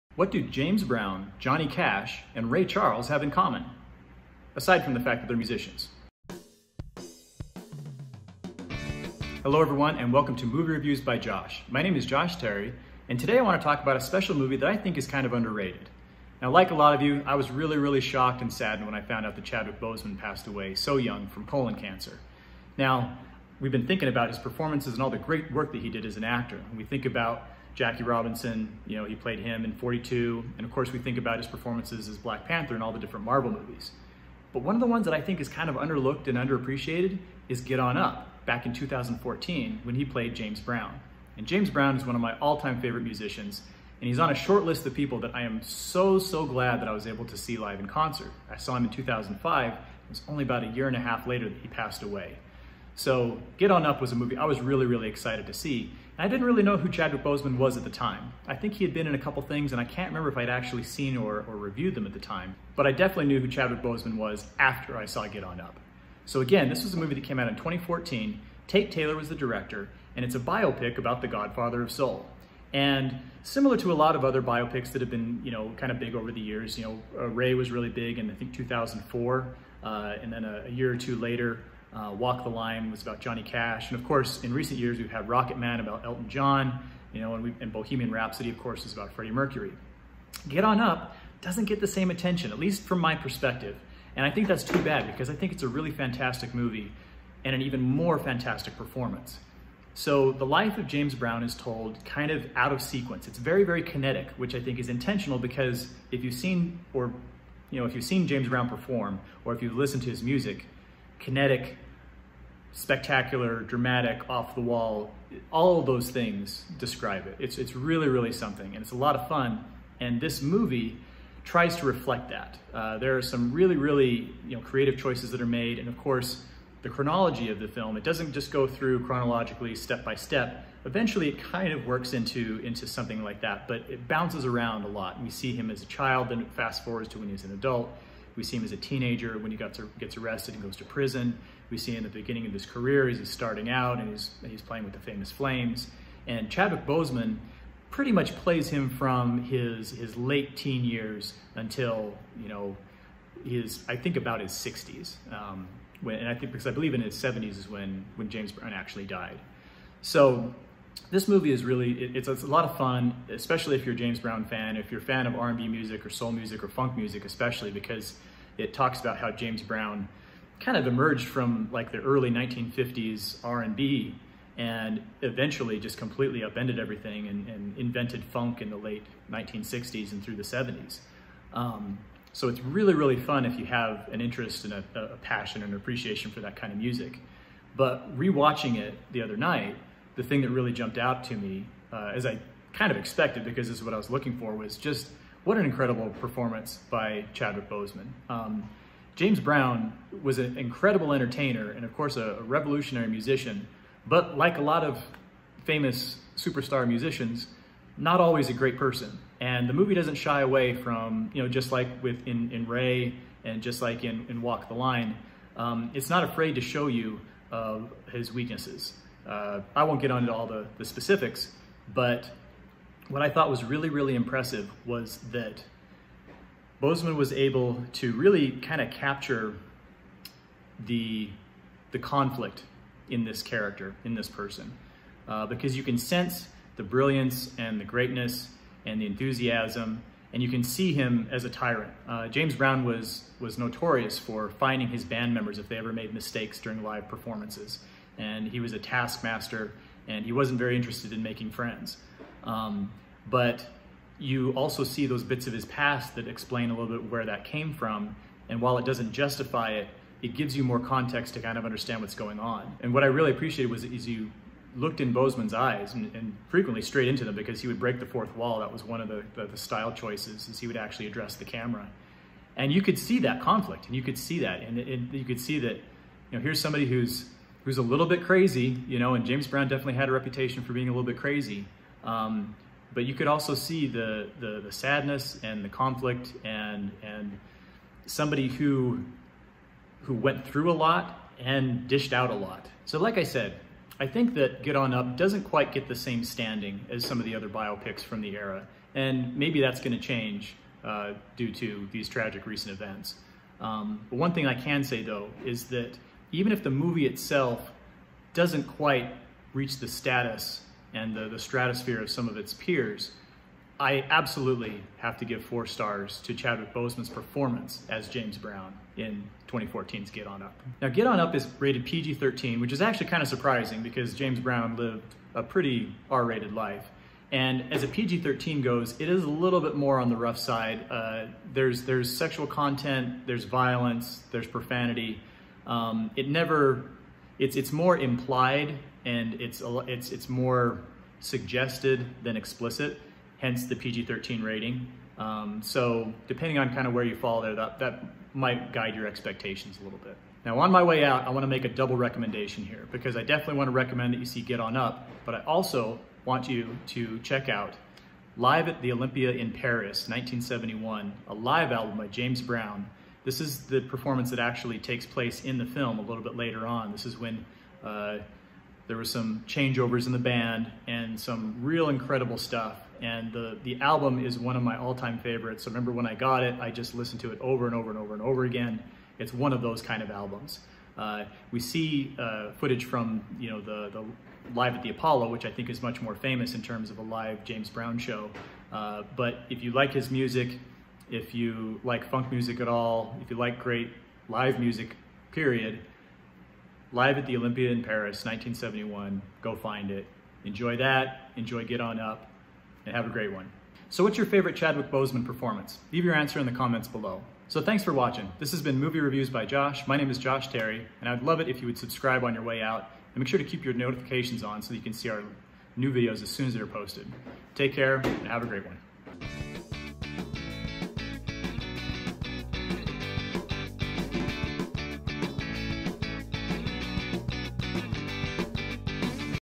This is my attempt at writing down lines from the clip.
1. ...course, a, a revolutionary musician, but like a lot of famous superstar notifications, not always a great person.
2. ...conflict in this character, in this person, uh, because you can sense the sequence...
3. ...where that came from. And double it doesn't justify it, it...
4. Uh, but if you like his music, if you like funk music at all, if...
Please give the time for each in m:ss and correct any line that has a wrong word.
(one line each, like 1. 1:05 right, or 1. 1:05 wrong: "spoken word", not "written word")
1. 3:21 wrong: "musicians", not "notifications"
2. 3:51 wrong: "brilliance", not "sequence"
3. 4:17 wrong: "while", not "double"
4. 6:28 right.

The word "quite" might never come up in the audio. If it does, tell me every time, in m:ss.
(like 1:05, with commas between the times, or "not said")
4:55, 5:08.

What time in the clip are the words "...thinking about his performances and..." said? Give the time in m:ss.
0:23.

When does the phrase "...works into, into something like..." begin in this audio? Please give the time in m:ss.
2:11.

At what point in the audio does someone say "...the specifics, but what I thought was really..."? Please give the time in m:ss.
3:40.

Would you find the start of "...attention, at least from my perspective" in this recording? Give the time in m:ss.
1:32.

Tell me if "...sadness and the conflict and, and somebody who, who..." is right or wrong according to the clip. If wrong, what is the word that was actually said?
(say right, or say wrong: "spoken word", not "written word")
right.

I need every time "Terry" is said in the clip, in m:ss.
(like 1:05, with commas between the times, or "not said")
0:12, 6:50.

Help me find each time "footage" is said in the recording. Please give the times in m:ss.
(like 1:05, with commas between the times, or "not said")
6:22.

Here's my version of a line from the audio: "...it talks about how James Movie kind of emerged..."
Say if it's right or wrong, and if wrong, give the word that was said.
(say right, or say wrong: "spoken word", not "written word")
wrong: "Brown", not "Movie".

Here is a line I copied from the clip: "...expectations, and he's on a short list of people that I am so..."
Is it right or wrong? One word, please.
wrong.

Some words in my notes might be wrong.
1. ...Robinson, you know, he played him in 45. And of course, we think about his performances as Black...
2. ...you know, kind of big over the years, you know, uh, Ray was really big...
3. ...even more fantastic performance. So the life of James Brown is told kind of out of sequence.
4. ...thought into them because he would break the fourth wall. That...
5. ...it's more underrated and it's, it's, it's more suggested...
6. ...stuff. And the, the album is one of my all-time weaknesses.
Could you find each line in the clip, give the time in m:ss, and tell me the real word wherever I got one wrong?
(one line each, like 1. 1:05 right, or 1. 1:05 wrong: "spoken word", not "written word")
1. 0:28 wrong: "42", not "45"
2. 1:15 right
3. 1:37 right
4. 4:26 wrong: "straight", not "thought"
5. 5:37 wrong: "implied", not "underrated"
6. 6:12 wrong: "favorites", not "weaknesses".